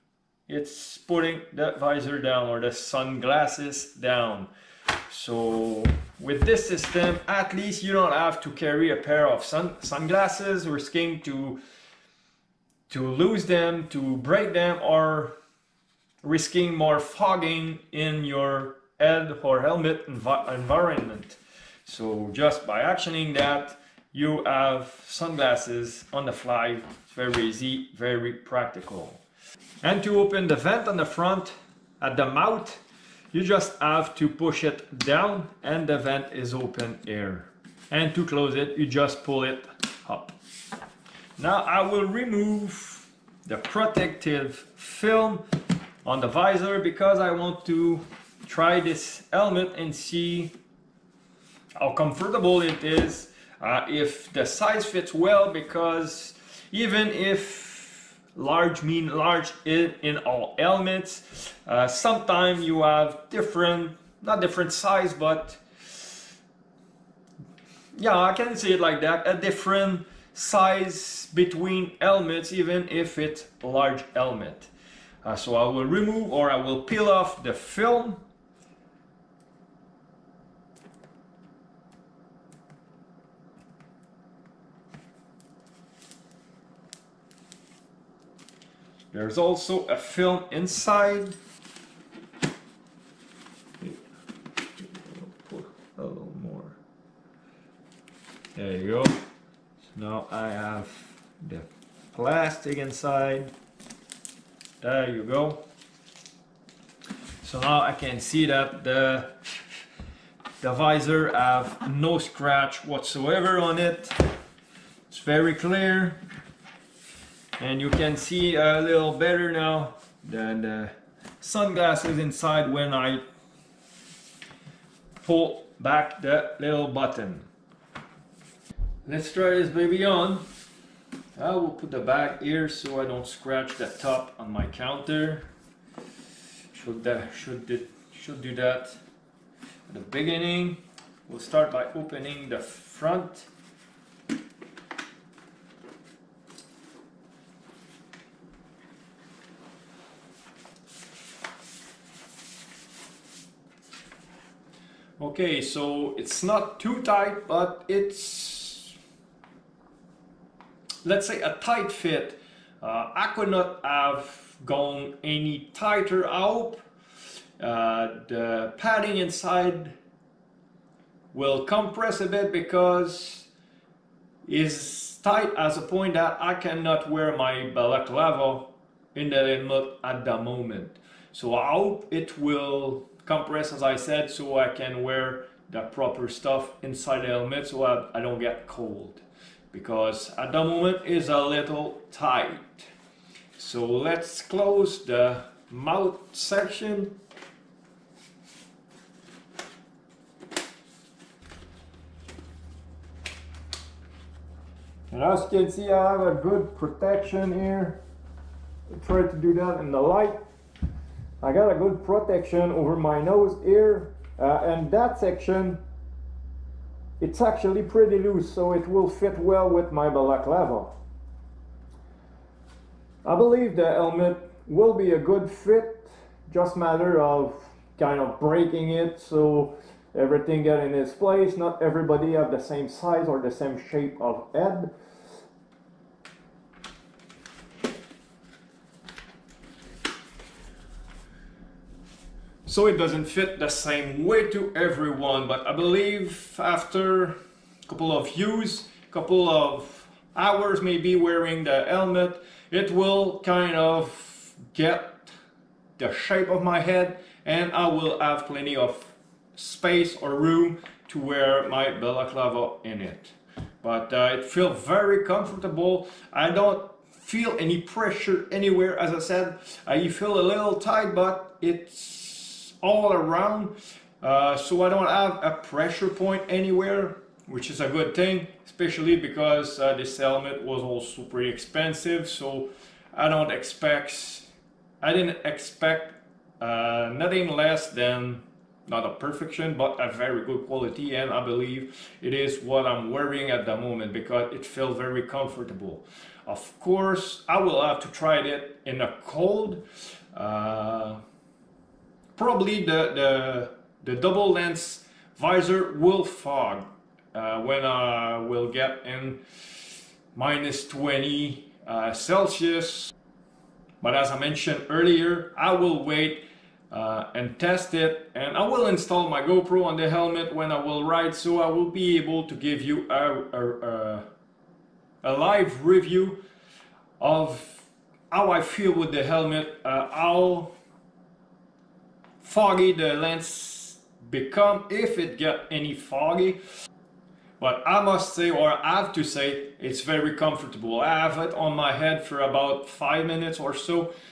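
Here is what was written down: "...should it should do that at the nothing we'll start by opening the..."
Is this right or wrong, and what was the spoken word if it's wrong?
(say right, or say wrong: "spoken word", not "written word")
wrong: "beginning", not "nothing".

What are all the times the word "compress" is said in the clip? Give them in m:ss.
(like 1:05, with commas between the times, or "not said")
2:51, 3:03.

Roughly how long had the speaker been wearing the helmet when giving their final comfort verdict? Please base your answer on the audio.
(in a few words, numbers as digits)
5 minutes.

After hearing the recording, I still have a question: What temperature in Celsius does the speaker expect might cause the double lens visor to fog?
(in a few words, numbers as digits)
-20.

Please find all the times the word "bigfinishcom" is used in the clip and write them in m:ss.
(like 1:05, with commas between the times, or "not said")
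not said.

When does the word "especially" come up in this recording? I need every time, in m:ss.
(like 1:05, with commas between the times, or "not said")
4:38.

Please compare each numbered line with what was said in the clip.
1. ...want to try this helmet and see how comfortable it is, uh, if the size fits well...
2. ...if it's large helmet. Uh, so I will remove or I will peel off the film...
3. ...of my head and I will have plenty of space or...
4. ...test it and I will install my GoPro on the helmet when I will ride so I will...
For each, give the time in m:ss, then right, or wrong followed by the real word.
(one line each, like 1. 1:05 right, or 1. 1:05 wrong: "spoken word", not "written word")
1. 0:47 right
2. 1:12 right
3. 4:16 right
4. 5:17 right.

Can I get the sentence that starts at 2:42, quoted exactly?
Uh, I could not have gone any tighter out.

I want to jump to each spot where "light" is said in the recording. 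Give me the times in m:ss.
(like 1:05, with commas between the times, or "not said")
3:29.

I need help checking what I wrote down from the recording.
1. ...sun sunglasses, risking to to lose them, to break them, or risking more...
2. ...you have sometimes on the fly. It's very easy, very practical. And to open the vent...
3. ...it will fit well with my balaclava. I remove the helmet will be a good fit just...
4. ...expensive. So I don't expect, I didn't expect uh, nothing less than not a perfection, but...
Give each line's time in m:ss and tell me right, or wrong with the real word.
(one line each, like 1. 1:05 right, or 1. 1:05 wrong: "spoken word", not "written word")
1. 0:09 right
2. 0:24 wrong: "sunglasses", not "sometimes"
3. 3:38 wrong: "believe", not "remove"
4. 4:41 right.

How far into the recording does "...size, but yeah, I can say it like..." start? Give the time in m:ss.
1:04.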